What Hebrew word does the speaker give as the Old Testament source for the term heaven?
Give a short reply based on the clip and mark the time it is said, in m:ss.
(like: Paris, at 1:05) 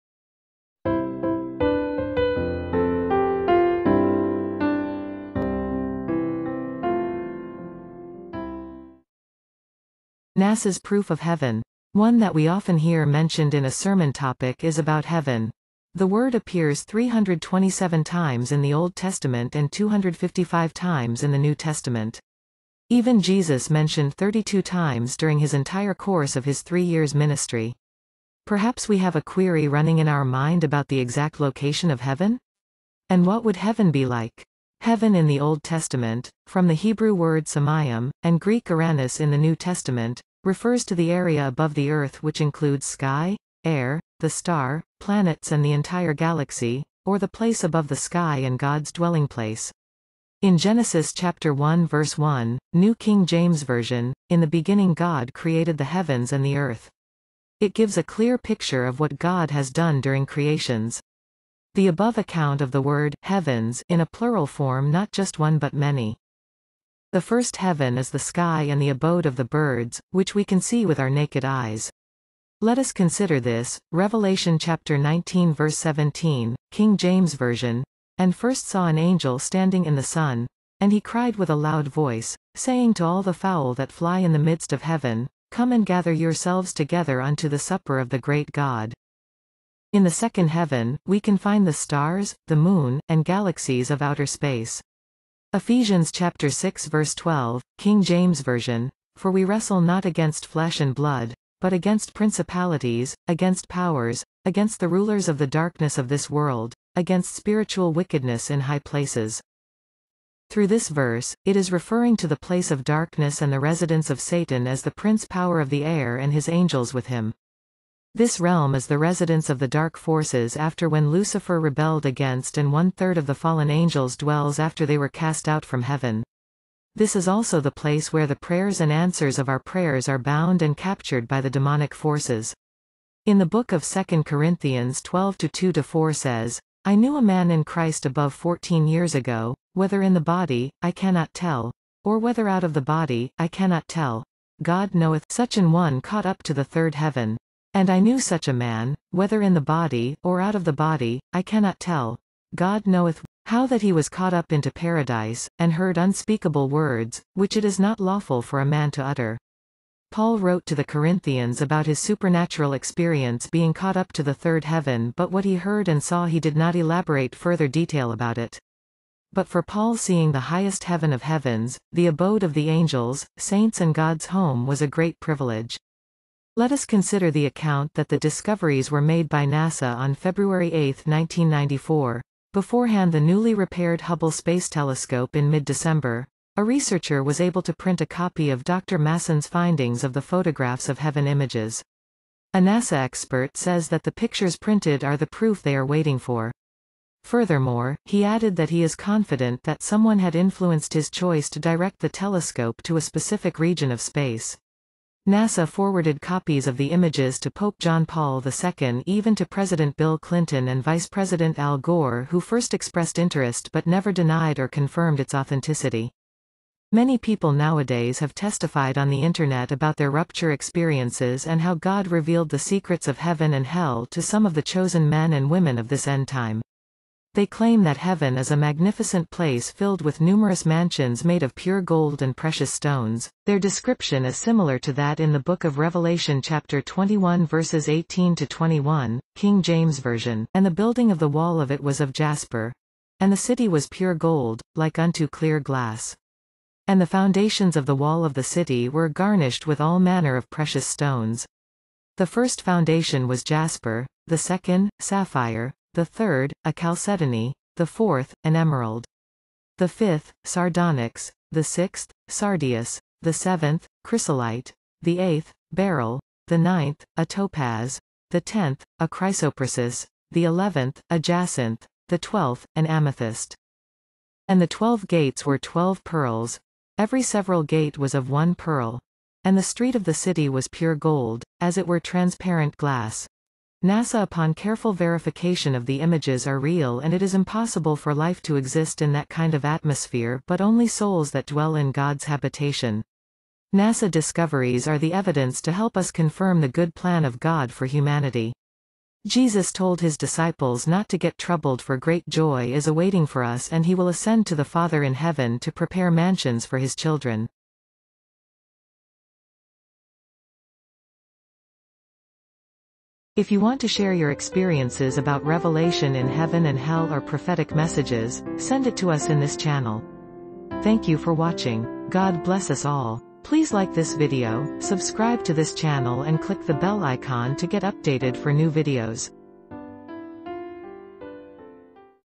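Samayim, at 0:37.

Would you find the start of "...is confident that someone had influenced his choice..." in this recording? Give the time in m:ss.
3:18.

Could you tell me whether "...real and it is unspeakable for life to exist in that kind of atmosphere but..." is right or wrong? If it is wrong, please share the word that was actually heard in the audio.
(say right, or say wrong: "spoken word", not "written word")
wrong: "impossible", not "unspeakable".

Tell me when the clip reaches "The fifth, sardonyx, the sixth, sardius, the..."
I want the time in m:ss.
4:19.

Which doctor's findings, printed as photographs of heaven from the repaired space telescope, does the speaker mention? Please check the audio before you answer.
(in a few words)
Dr. Masson.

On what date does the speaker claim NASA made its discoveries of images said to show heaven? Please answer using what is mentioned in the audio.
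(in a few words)
February 8, 1994.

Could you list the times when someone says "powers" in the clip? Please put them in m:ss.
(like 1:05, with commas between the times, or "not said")
1:43, 1:55.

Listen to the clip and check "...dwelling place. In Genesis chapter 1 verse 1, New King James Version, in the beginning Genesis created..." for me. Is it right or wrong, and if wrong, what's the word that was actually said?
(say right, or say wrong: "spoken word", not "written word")
wrong: "God", not "Genesis".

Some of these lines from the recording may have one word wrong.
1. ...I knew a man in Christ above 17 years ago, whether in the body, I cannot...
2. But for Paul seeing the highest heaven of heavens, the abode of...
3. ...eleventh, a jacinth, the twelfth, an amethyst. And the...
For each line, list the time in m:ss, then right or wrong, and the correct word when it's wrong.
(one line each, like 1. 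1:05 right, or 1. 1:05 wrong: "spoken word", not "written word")
1. 2:16 wrong: "14", not "17"
2. 2:49 right
3. 4:30 right.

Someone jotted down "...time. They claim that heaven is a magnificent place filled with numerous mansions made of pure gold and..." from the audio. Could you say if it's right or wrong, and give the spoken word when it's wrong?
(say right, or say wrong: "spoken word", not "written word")
right.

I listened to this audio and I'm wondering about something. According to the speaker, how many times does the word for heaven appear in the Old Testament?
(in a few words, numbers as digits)
327.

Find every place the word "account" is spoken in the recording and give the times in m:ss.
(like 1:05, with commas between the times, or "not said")
1:02, 2:57.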